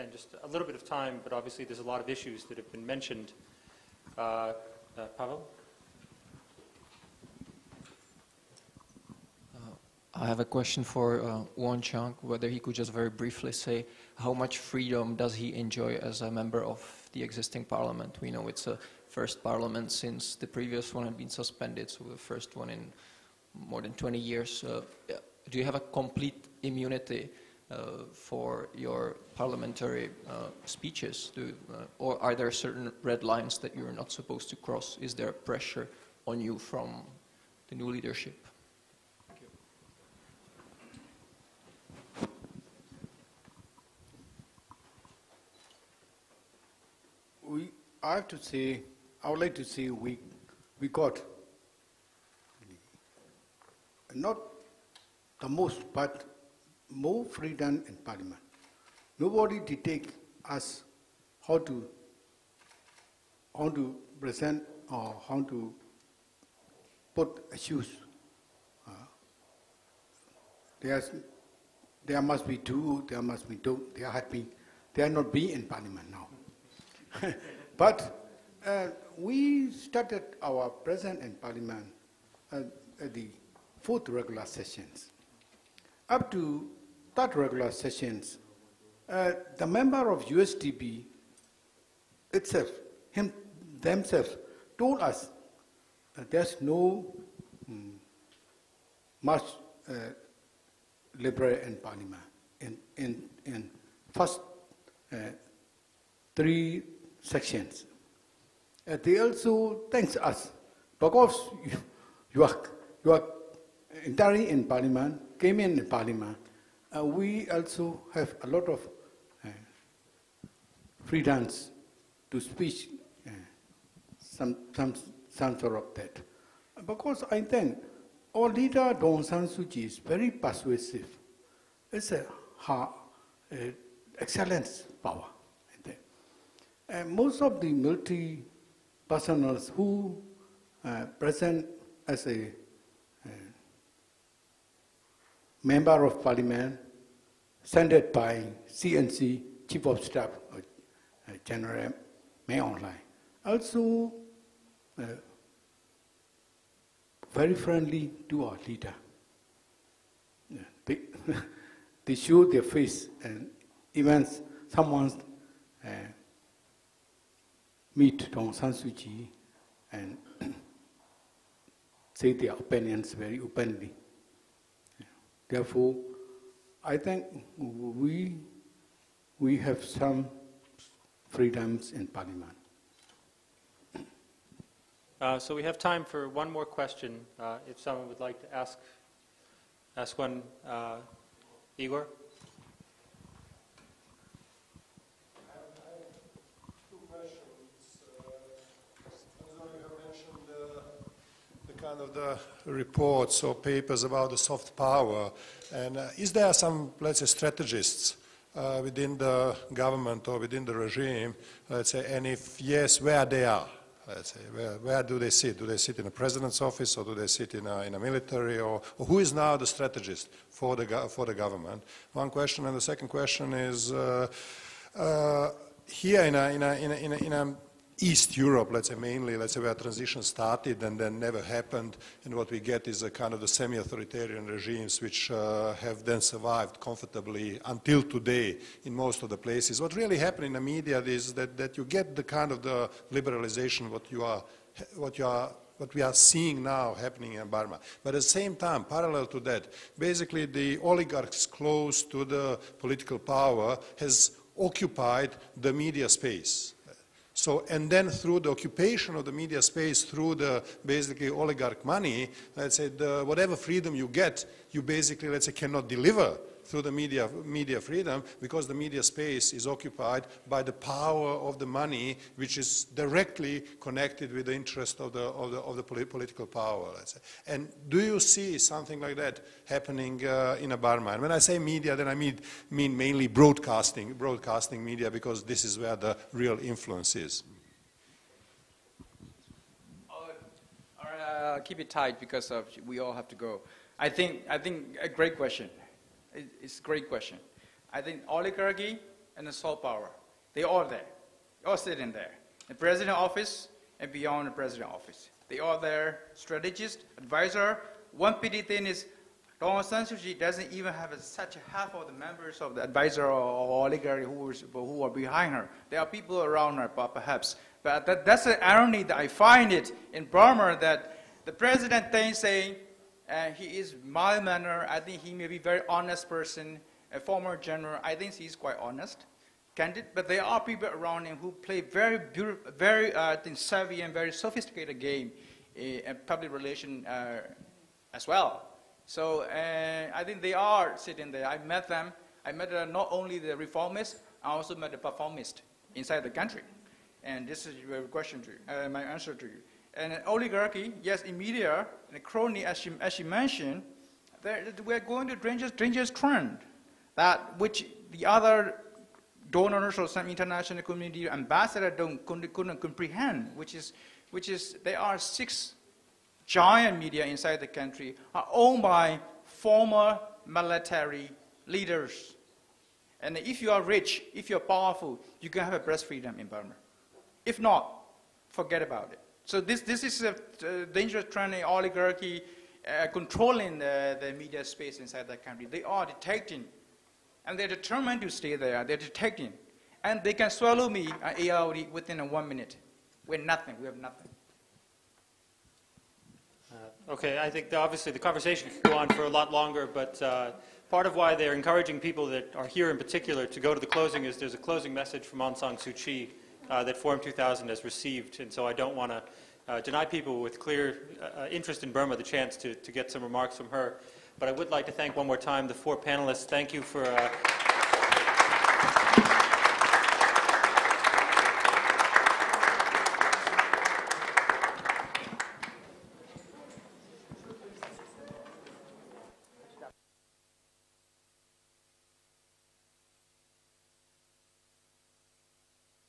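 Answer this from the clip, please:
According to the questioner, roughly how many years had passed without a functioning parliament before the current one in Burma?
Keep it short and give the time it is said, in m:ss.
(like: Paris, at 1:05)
more than 20 years, at 0:23.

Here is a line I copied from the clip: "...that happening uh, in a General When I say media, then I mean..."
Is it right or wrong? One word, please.
wrong.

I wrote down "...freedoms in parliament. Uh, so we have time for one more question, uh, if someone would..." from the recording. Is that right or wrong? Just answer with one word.
right.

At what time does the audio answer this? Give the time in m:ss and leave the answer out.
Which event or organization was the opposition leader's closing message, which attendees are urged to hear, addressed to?
6:46.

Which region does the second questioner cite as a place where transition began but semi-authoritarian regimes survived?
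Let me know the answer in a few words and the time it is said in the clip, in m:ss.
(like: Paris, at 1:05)
East Europe, at 3:47.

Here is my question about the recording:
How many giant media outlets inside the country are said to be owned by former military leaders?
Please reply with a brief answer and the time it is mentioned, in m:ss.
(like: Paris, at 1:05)
6, at 6:05.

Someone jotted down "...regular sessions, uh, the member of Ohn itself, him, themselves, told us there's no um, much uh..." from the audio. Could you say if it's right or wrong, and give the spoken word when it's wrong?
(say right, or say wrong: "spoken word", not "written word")
wrong: "USDP", not "Ohn".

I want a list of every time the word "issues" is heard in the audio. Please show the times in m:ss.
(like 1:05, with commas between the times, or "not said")
0:02, 1:07.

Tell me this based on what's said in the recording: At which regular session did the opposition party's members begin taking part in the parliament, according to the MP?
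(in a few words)
fourth regular sessions.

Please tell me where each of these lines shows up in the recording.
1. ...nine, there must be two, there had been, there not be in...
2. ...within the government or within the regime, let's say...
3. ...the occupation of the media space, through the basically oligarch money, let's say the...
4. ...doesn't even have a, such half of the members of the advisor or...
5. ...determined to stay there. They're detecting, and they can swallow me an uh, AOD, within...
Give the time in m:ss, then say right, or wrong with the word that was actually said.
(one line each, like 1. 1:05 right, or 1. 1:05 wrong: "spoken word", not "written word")
1. 1:12 wrong: "two", not "nine"
2. 3:28 right
3. 4:18 right
4. 5:10 right
5. 6:27 right.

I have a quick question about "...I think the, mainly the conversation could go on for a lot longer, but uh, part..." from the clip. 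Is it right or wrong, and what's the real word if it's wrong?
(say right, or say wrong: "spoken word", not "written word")
wrong: "obviously", not "mainly".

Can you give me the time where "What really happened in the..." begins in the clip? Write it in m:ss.
3:59.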